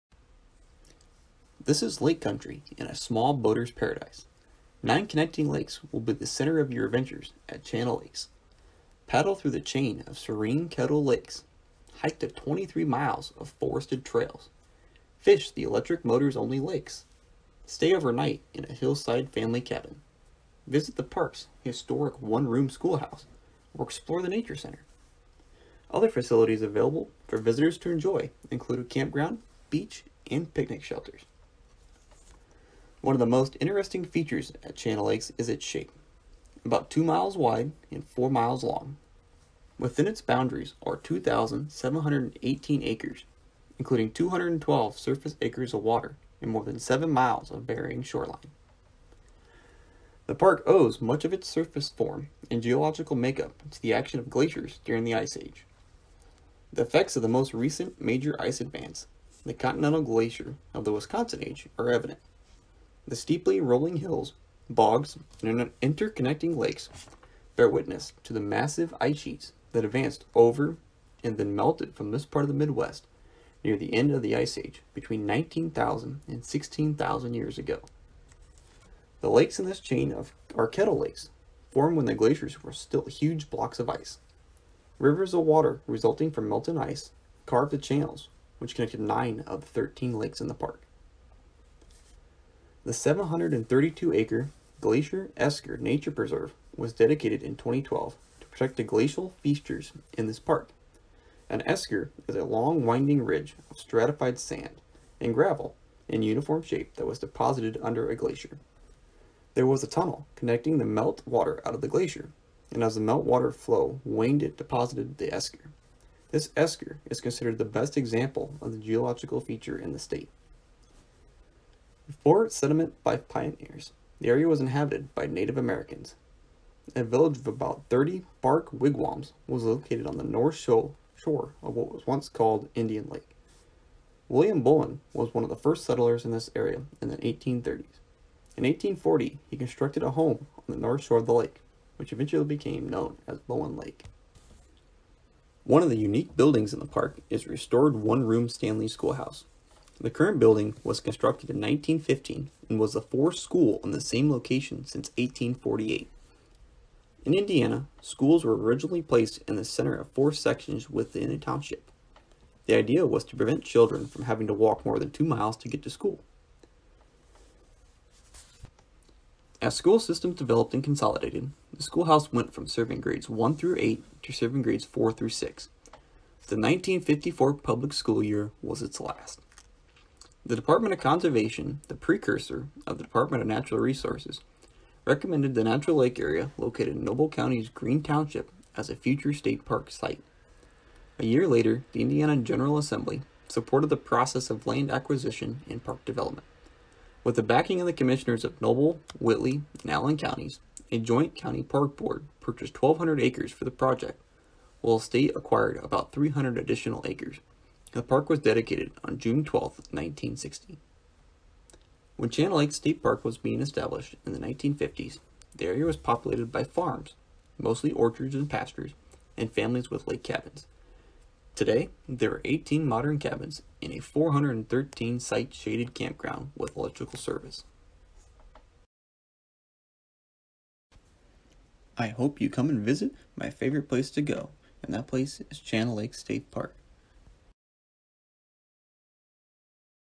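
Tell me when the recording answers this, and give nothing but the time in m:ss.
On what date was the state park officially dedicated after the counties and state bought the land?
3:29.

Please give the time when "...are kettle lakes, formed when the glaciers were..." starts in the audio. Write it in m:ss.
1:20.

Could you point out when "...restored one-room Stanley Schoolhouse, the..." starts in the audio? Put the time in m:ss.
2:27.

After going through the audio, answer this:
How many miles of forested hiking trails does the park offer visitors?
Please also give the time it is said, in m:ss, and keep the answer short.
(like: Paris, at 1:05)
23, at 0:12.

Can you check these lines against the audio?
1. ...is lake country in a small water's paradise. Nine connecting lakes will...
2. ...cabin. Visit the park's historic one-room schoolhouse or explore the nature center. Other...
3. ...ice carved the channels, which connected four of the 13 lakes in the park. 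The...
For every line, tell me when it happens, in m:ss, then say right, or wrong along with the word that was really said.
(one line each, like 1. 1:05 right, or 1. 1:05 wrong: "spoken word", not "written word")
1. 0:01 wrong: "boater", not "water"
2. 0:19 right
3. 1:26 wrong: "nine", not "four".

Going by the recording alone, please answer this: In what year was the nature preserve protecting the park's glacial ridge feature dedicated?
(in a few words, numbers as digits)
2012.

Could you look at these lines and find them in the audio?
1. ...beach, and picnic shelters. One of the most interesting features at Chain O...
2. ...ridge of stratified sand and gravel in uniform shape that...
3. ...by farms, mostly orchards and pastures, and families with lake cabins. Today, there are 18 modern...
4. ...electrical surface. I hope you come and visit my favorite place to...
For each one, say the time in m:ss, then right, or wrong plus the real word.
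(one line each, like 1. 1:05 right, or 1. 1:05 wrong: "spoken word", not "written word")
1. 0:29 right
2. 1:43 right
3. 3:36 right
4. 3:46 wrong: "service", not "surface".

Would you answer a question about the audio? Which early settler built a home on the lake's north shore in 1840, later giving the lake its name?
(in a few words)
William Bowen.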